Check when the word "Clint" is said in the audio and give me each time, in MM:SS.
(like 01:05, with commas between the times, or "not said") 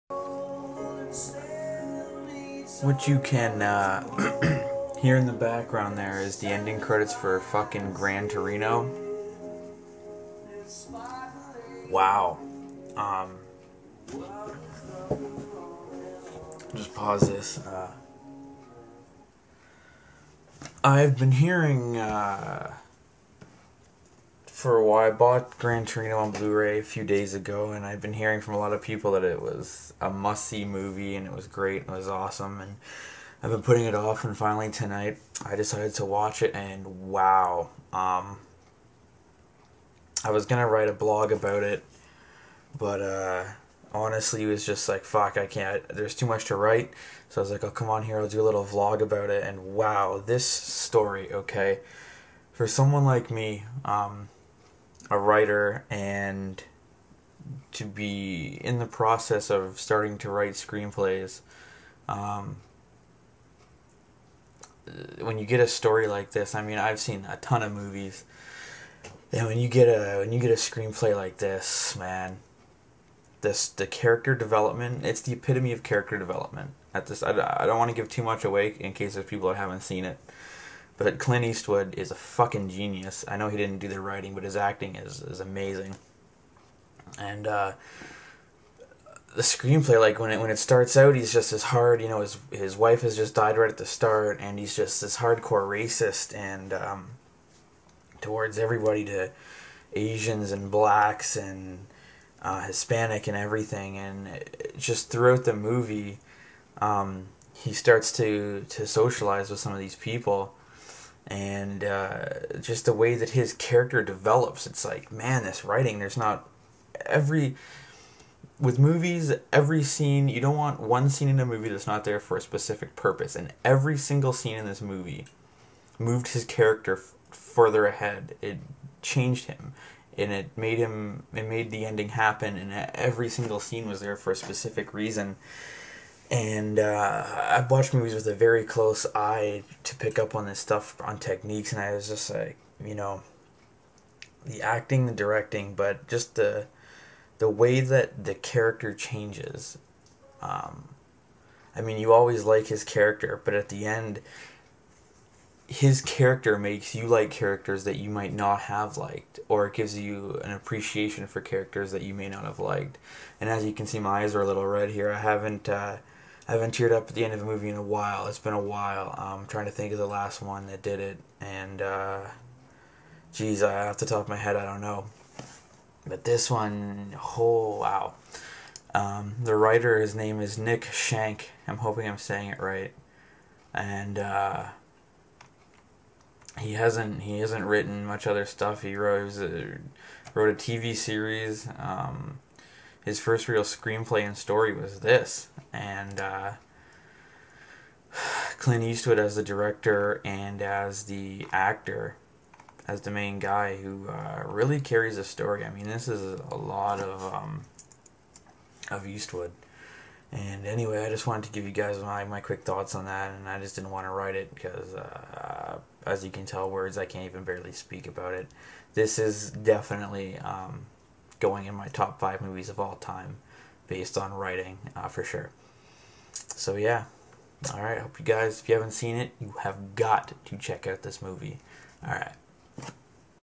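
01:21, 03:18.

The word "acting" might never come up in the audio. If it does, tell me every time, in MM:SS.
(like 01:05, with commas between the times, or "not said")
01:24, 02:24.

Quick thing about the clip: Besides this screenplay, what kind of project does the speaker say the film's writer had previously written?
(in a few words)
A TV series.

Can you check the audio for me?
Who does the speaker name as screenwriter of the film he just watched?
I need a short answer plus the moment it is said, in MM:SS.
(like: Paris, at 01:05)
Nick Schenk, at 03:00.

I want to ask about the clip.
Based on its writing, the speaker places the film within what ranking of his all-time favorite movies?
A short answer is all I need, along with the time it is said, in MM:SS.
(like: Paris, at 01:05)
Top 5, at 03:41.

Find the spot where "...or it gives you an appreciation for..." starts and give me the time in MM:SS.
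02:39.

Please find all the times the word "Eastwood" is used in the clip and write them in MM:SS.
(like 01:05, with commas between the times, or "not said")
01:21, 03:18, 03:29.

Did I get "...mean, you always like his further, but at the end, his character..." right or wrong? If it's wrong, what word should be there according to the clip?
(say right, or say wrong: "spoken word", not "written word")
wrong: "character", not "further".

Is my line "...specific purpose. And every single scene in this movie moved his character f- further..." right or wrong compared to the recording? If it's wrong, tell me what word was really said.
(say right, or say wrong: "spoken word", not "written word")
right.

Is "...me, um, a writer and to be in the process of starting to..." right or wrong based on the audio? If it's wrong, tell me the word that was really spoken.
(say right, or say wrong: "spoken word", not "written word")
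right.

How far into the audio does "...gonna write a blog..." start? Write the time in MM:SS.
00:40.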